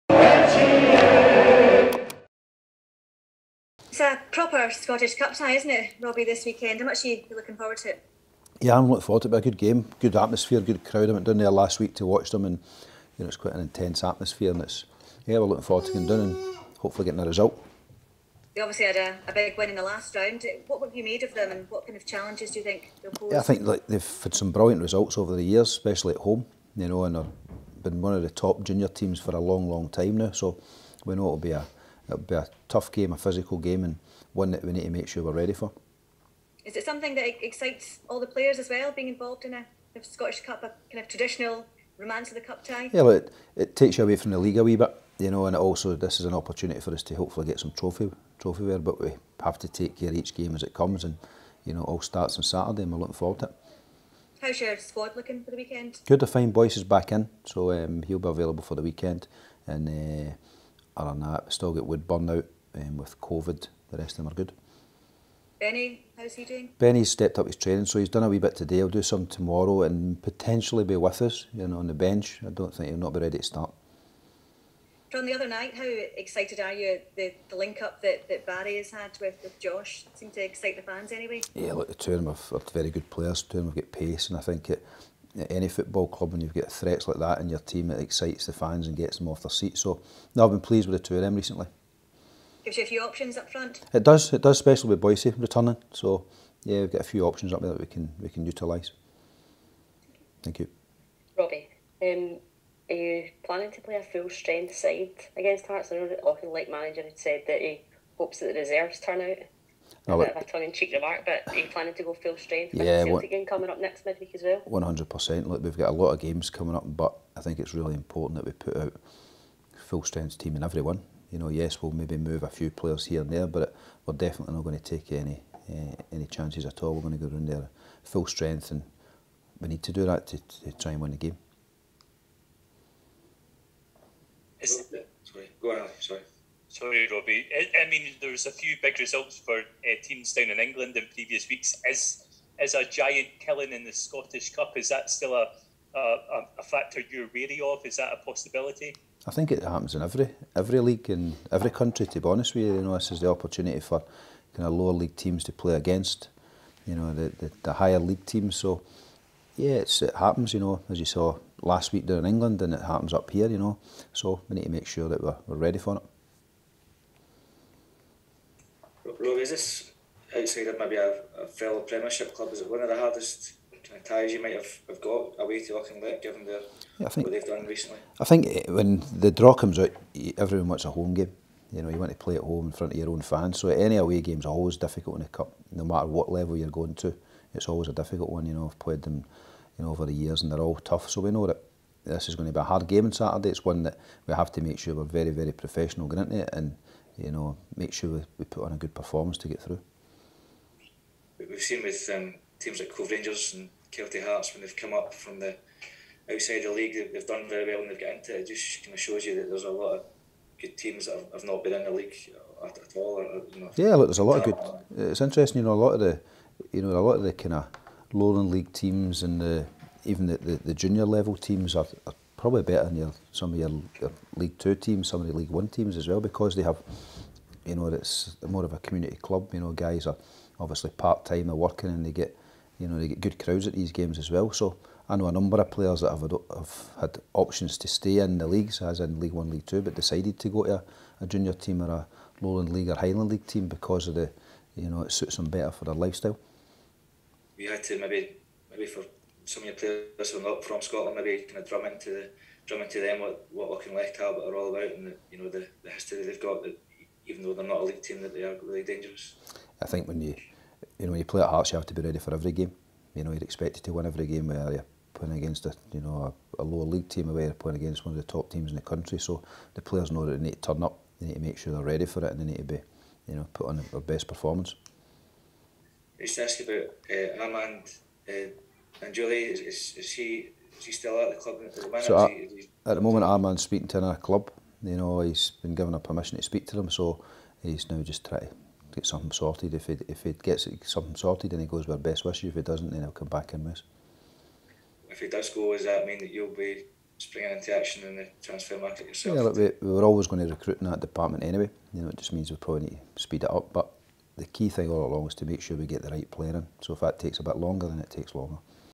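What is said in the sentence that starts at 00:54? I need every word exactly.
How's your squad looking for the weekend?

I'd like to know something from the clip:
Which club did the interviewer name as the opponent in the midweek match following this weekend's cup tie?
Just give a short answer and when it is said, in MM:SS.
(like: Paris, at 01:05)
Celtic, at 01:53.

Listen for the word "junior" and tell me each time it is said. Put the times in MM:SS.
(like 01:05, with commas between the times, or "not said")
00:28, 03:40, 04:01.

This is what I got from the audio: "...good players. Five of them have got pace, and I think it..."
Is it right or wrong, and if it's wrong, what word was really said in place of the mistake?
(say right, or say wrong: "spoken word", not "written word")
wrong: "Two", not "Five".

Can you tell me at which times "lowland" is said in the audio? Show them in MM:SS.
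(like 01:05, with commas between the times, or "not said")
03:38, 04:02.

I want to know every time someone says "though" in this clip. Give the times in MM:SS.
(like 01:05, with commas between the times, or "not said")
04:17.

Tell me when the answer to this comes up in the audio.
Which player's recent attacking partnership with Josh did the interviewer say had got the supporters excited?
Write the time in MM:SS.
01:18.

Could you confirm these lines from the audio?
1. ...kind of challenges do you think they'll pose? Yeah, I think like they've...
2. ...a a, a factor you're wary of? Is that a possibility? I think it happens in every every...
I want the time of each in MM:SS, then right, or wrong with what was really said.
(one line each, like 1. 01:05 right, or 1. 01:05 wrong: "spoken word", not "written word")
1. 00:21 right
2. 02:25 right.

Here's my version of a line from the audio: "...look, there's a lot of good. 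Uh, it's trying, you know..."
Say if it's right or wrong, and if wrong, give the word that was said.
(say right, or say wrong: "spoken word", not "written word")
wrong: "interesting", not "trying".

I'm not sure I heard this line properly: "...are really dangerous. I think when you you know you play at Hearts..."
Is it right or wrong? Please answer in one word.
right.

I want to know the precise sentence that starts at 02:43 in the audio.
You know, so we need to make sure that we're, we're ready for it.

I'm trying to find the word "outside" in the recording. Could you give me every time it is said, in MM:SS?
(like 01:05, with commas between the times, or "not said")
02:50, 03:26.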